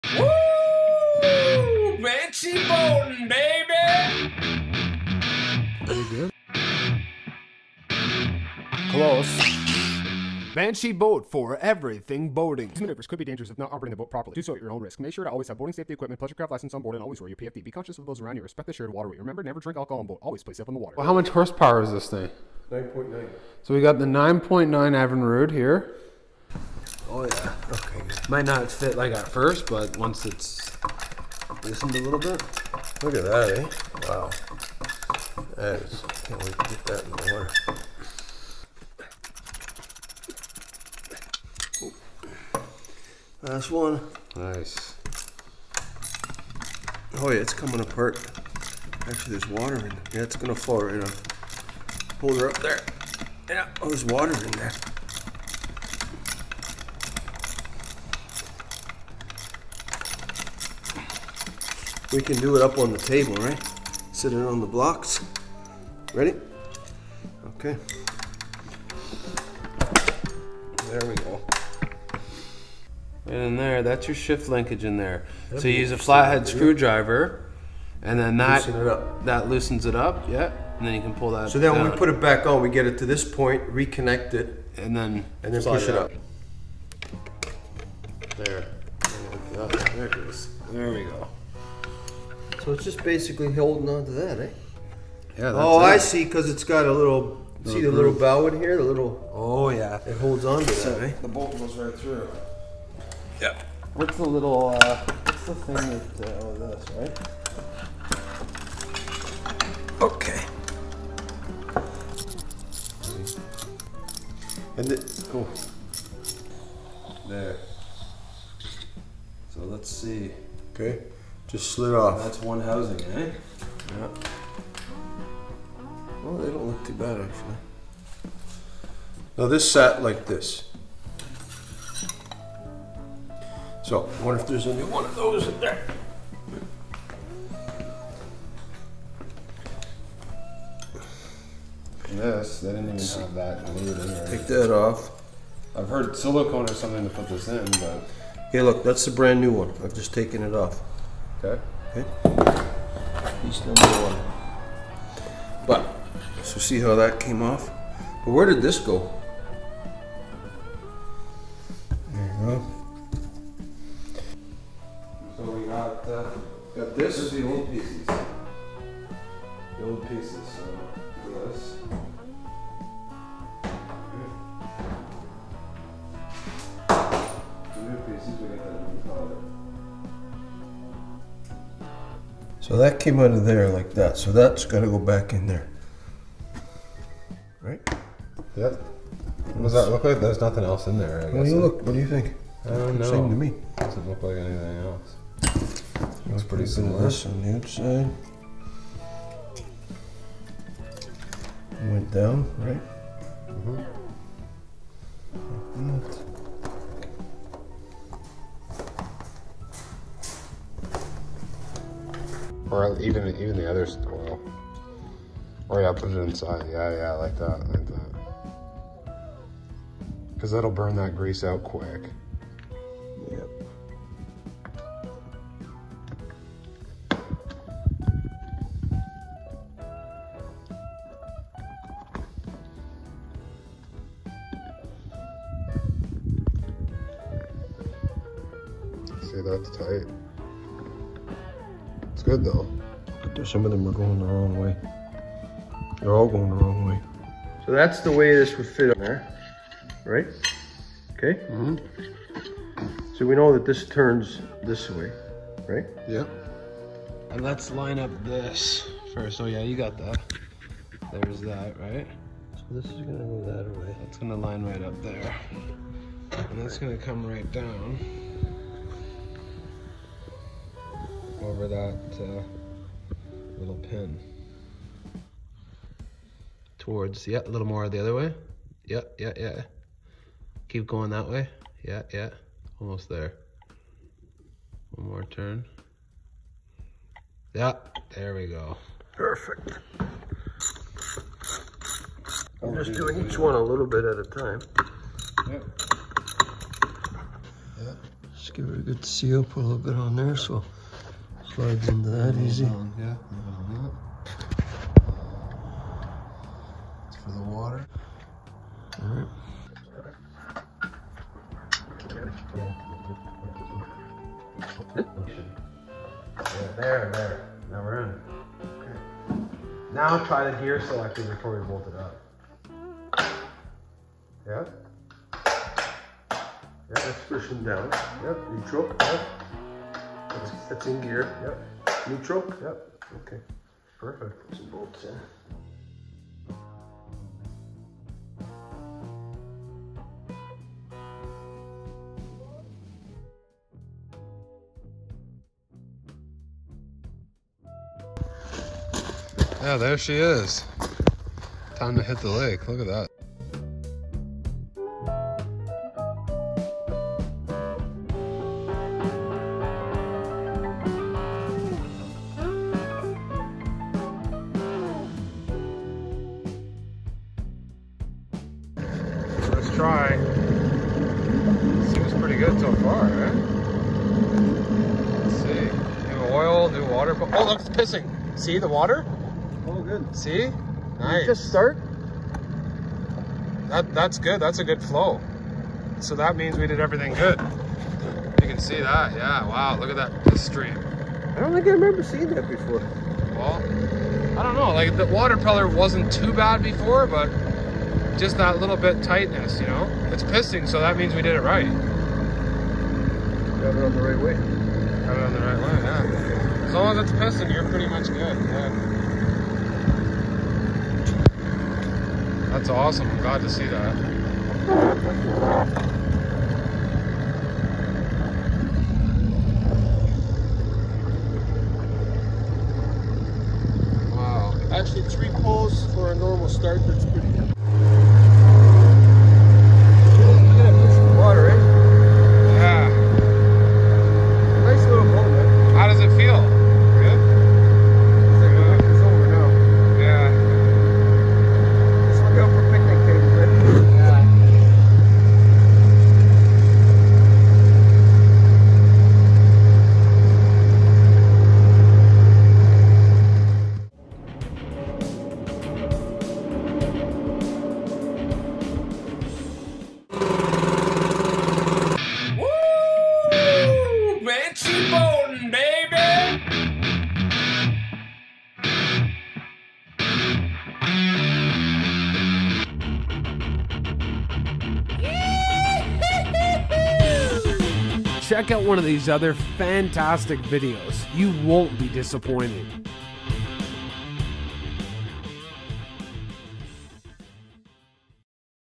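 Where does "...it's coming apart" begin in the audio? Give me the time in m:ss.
0:47.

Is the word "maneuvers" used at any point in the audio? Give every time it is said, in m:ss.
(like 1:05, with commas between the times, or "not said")
0:12.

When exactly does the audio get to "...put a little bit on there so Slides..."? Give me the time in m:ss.
4:59.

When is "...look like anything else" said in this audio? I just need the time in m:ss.
3:14.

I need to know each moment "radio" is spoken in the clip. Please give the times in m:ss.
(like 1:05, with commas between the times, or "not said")
not said.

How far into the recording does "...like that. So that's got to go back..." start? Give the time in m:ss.
3:03.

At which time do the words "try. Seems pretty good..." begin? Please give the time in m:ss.
6:09.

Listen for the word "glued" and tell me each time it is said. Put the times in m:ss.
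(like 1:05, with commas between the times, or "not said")
2:23.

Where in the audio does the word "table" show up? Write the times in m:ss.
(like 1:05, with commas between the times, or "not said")
1:02.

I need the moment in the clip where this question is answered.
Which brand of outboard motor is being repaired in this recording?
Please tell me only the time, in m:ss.
0:24.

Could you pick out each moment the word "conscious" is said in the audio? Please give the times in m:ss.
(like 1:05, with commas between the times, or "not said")
0:17.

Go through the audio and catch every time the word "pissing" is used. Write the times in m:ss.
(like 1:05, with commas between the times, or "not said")
6:17, 6:40, 6:47.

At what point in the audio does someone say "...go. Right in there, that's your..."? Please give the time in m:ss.
1:11.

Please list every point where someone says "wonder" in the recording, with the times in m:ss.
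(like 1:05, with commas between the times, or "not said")
2:14.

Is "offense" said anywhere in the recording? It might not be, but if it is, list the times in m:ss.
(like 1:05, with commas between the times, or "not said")
not said.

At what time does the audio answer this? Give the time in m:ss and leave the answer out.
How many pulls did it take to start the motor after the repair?
7:05.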